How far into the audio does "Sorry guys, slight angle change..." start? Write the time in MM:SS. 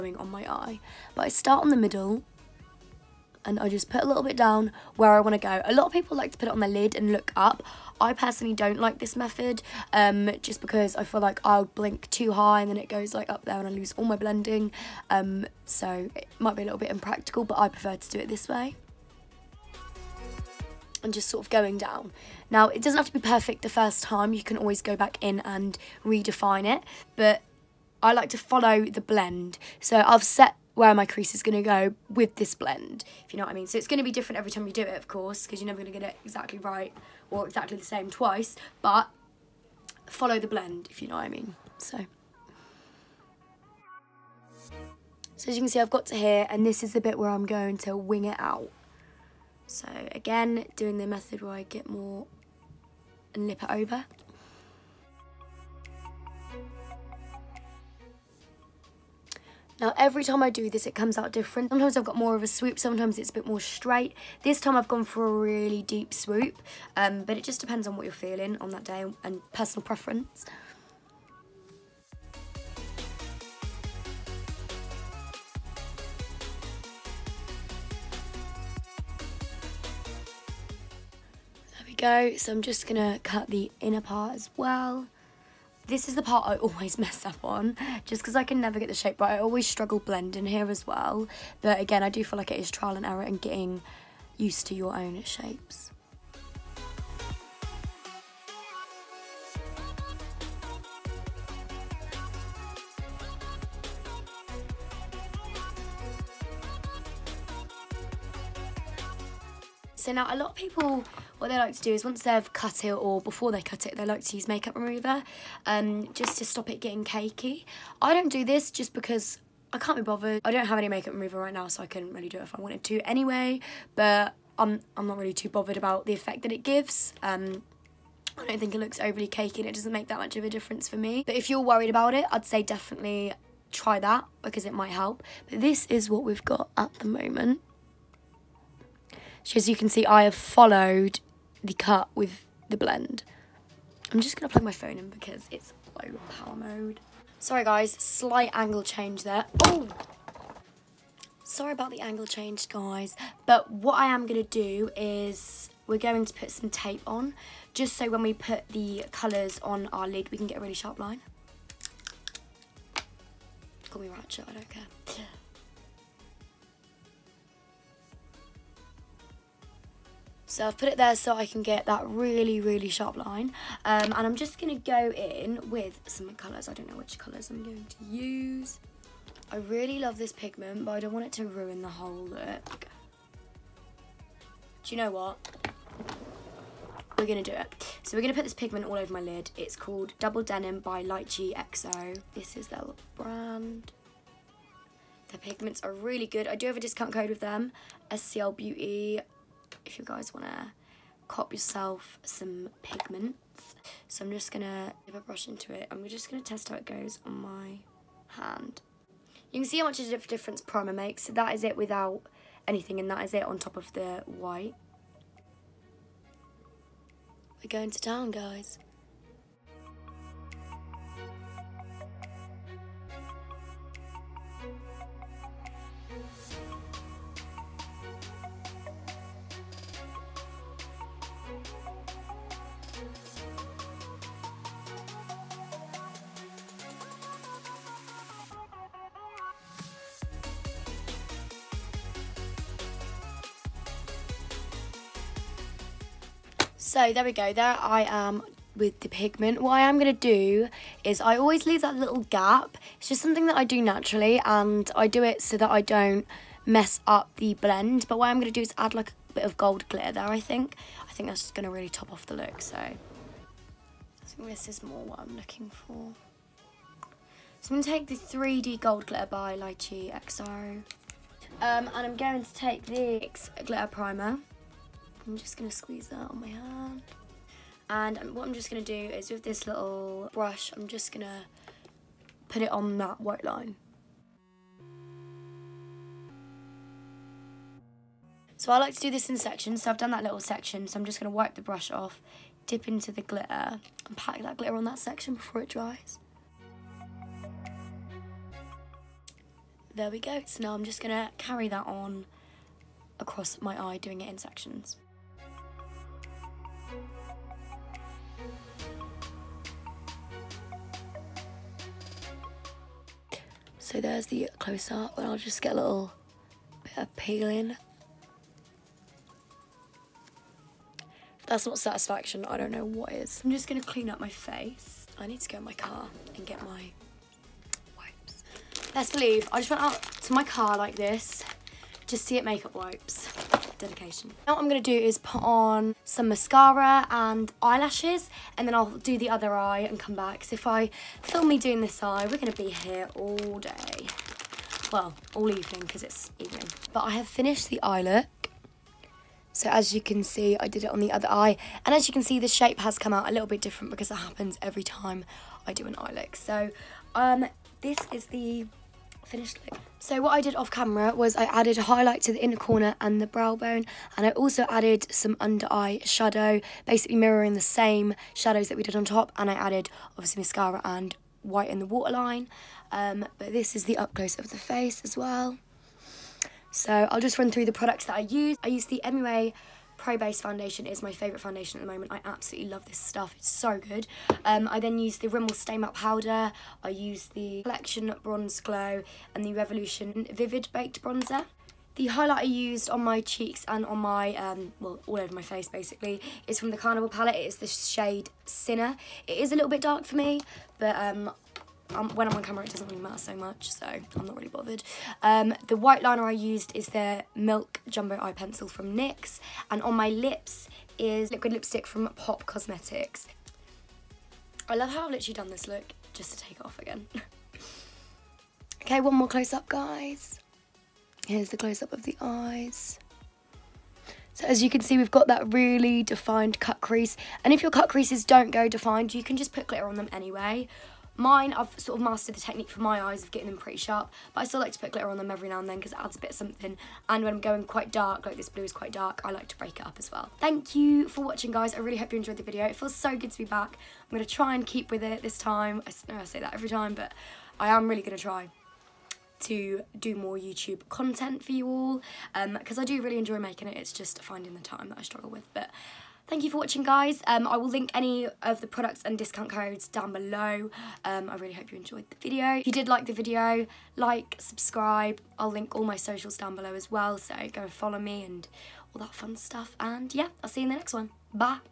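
02:27.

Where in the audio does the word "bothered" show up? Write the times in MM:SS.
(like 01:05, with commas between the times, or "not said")
02:00, 02:05, 06:44.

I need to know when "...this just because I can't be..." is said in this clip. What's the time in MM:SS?
01:58.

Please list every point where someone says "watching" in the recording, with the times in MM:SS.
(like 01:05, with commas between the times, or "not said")
07:21, 07:36.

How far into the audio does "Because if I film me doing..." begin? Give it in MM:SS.
05:40.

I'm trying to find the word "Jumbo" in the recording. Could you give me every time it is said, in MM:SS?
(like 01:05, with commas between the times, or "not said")
06:47.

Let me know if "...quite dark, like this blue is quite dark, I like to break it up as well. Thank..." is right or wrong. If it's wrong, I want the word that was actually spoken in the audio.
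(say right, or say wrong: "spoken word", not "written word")
right.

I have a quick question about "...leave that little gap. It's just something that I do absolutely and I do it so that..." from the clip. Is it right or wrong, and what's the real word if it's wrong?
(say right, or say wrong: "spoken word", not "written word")
wrong: "naturally", not "absolutely".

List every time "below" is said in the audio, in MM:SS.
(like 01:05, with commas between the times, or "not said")
07:40, 07:46.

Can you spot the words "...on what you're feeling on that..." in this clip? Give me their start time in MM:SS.
01:07.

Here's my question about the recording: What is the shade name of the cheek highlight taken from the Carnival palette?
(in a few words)
Sinner.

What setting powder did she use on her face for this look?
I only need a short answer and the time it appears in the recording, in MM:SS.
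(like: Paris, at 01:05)
Rimmel Stay Matte Powder, at 06:25.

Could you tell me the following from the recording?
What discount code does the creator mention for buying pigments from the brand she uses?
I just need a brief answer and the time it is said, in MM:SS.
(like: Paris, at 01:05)
SCL Beauty, at 03:18.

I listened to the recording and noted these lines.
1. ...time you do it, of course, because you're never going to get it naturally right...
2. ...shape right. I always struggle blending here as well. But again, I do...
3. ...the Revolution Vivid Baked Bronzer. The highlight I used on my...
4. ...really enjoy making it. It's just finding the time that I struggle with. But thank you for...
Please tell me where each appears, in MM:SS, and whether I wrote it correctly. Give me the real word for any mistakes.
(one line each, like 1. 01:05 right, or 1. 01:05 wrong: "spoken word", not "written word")
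1. 00:34 wrong: "exactly", not "naturally"
2. 01:28 right
3. 06:29 right
4. 07:33 right.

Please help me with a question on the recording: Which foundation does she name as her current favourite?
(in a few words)
MUA Pro Base.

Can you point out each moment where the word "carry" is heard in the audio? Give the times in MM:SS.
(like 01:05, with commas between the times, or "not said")
05:01.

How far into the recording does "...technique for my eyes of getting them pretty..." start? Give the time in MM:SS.
07:12.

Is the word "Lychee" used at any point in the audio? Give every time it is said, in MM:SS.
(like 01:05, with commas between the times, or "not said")
03:11, 04:29.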